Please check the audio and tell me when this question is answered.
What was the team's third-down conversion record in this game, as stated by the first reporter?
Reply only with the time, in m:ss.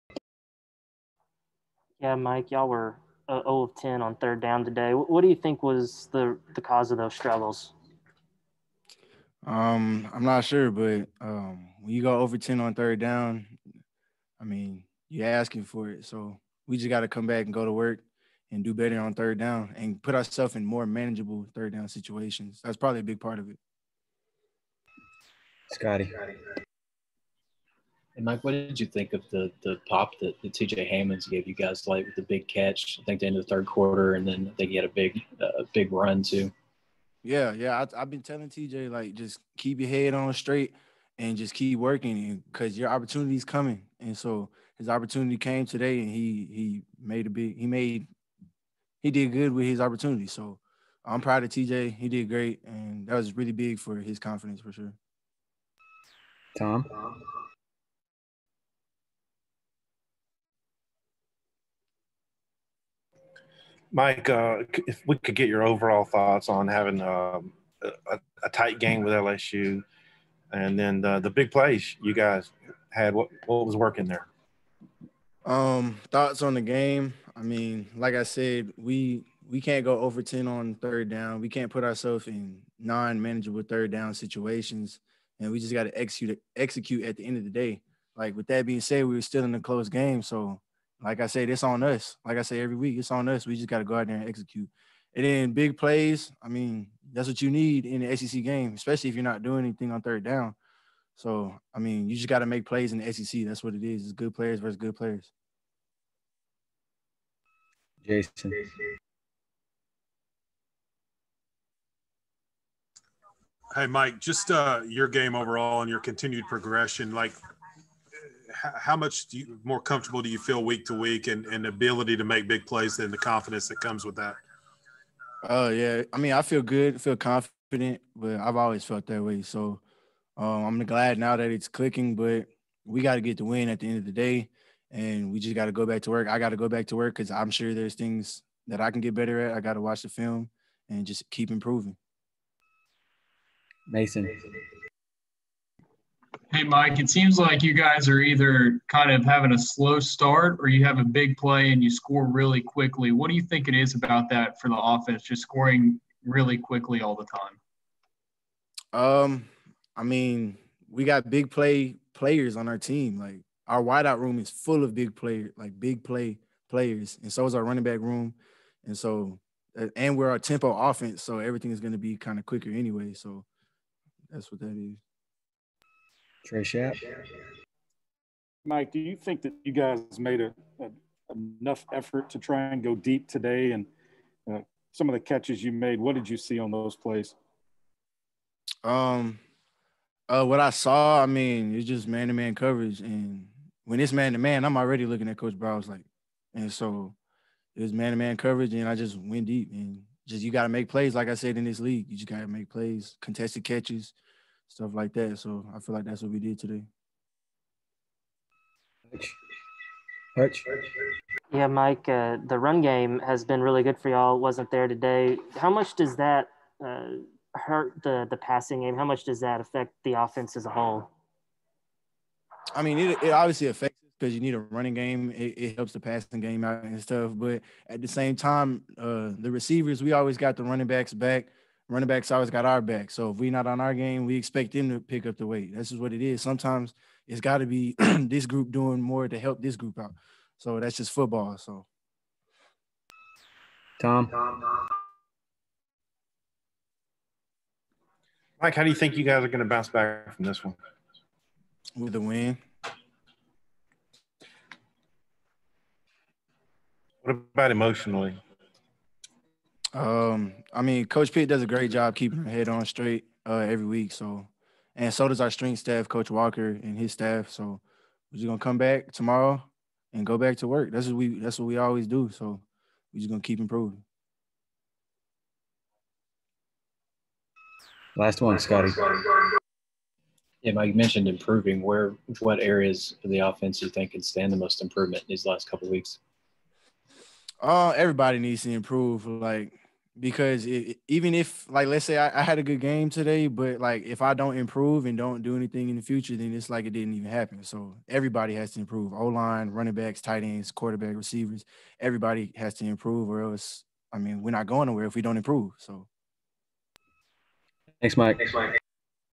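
0:03.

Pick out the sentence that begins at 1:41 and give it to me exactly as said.
So, I mean, you just got to make plays in the SEC.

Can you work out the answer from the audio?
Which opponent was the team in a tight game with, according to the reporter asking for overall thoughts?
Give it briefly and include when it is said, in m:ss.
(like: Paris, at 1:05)
LSU, at 1:09.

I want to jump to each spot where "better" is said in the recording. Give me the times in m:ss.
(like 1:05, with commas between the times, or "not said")
0:18, 2:19.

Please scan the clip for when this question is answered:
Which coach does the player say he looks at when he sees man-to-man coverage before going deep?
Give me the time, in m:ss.
3:15.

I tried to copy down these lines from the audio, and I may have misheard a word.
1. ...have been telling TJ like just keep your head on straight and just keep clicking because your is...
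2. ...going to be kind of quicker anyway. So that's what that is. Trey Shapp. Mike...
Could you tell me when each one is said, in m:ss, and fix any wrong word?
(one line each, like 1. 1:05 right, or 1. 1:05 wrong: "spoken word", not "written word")
1. 0:37 wrong: "working", not "clicking"
2. 2:51 right.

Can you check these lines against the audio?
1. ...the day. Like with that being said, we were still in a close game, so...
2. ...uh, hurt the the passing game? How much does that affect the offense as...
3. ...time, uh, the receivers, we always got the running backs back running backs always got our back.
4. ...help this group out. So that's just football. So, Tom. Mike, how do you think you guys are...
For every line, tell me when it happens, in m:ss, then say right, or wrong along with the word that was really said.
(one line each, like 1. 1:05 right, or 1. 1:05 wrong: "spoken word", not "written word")
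1. 1:27 right
2. 3:36 right
3. 3:48 right
4. 3:59 right.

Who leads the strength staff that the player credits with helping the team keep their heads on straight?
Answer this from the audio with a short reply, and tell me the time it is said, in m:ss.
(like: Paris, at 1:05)
Coach Walker, at 4:26.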